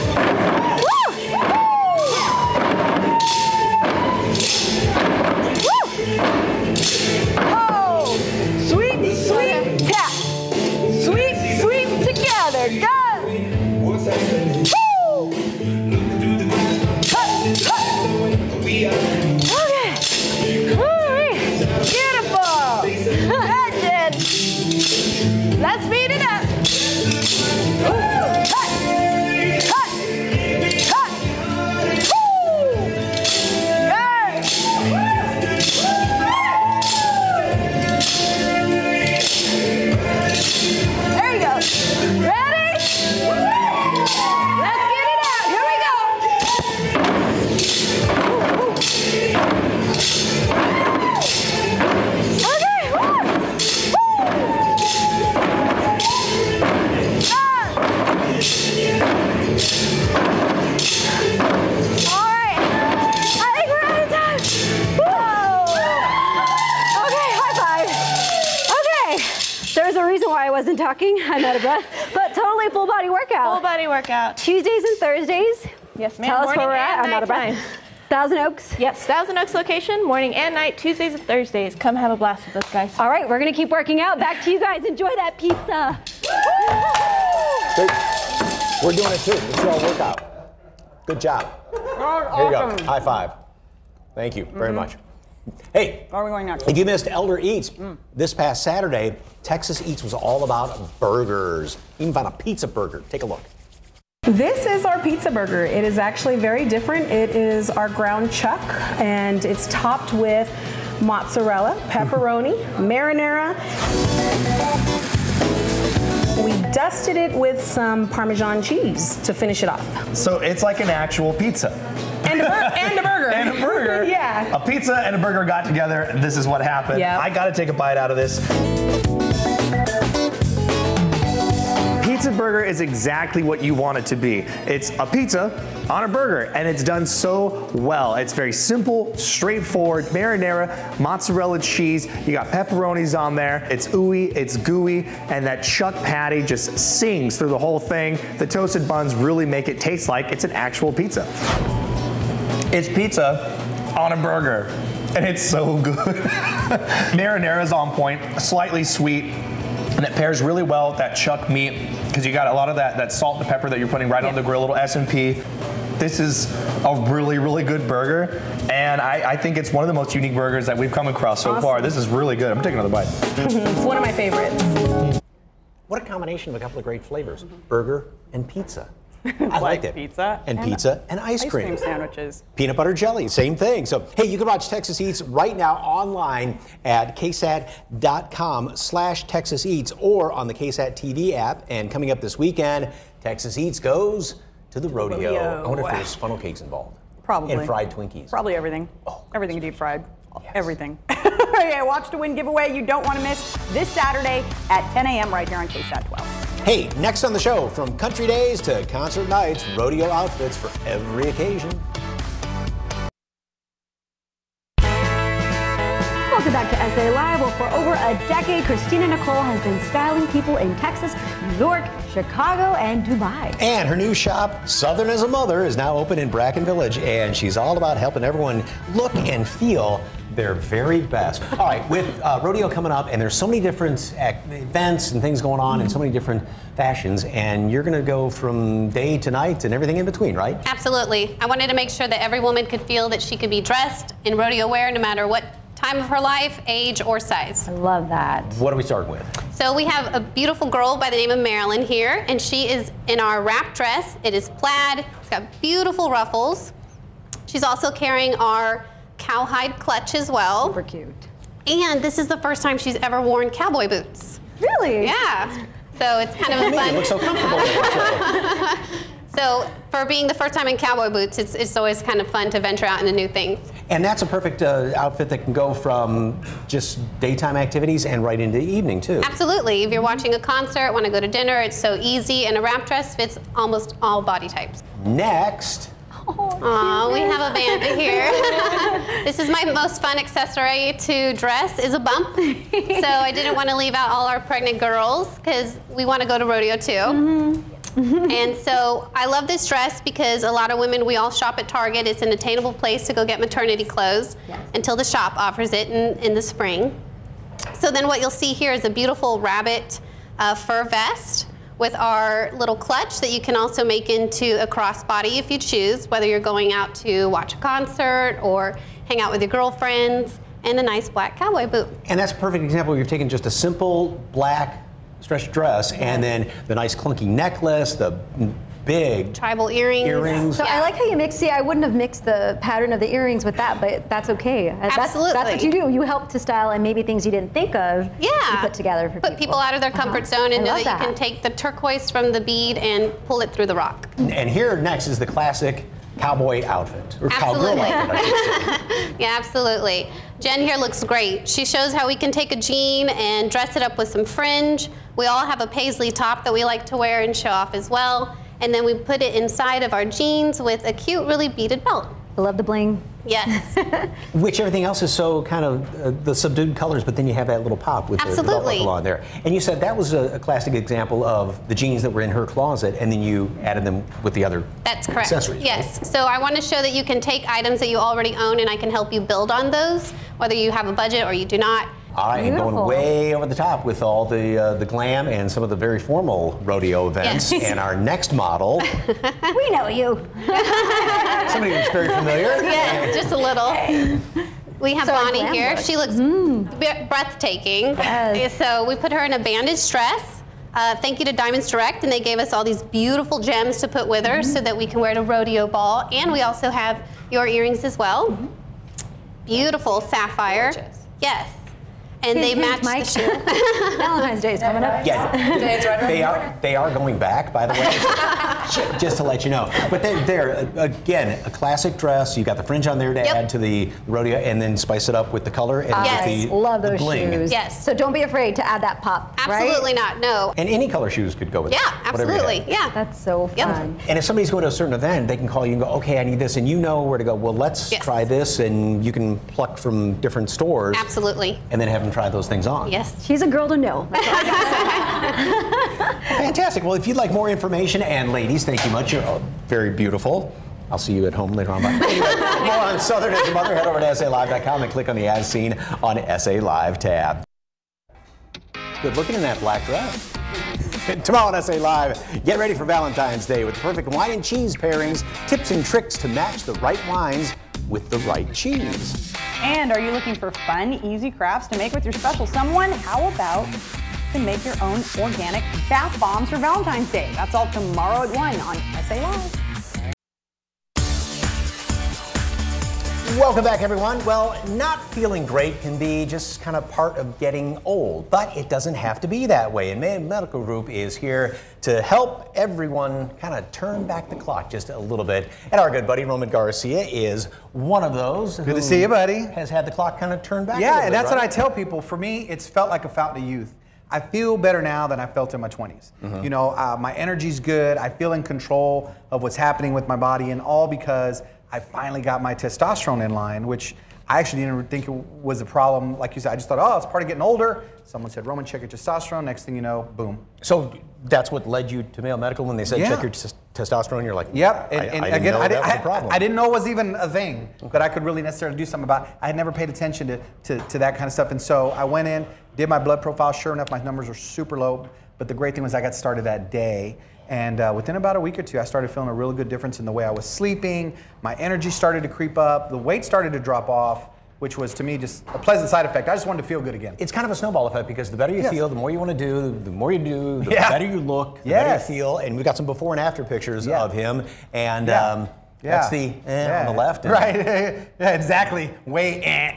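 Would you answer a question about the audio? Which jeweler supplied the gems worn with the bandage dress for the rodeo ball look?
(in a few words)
Diamonds Direct.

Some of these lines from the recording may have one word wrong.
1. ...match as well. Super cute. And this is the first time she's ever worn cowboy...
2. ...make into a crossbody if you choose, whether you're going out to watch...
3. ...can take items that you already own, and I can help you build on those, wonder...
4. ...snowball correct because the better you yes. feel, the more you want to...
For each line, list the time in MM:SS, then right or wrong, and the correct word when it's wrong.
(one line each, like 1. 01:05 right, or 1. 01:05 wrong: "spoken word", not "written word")
1. 04:19 wrong: "clutch", not "match"
2. 05:13 right
3. 06:17 wrong: "whether", not "wonder"
4. 09:07 wrong: "effect", not "correct".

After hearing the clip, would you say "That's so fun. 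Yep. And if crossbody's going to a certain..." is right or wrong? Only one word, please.
wrong.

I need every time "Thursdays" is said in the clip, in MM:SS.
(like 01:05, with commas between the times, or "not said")
01:14, 01:21.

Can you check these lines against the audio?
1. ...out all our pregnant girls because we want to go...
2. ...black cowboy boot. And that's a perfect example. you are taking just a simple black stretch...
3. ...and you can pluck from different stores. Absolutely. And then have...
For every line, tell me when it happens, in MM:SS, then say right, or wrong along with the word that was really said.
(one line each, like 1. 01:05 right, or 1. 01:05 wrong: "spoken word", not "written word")
1. 04:53 right
2. 05:21 right
3. 07:18 right.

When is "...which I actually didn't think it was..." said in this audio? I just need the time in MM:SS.
08:33.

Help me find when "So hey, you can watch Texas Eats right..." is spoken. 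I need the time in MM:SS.
03:03.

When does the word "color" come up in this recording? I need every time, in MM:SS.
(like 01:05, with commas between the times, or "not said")
06:06, 07:05, 07:10.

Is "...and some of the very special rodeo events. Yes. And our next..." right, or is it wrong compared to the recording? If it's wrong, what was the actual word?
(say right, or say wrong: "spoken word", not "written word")
wrong: "formal", not "special".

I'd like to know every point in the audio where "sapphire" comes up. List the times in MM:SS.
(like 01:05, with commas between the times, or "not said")
06:50.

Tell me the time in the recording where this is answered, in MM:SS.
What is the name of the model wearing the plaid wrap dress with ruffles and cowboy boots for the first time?
04:11.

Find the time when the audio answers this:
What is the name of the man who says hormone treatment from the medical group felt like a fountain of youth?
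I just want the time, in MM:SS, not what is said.
08:16.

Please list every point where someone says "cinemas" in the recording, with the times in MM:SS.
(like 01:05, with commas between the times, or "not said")
not said.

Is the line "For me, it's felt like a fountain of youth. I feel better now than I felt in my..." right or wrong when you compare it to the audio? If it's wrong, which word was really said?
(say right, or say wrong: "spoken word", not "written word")
right.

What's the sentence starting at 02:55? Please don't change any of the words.
What a combination of a couple of great flavors, mm-hmm.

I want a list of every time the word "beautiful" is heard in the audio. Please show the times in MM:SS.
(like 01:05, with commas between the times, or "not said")
04:10, 04:15, 05:08, 06:42, 06:49, 07:29.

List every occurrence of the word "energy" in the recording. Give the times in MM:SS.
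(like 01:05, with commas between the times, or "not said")
08:27, 09:01.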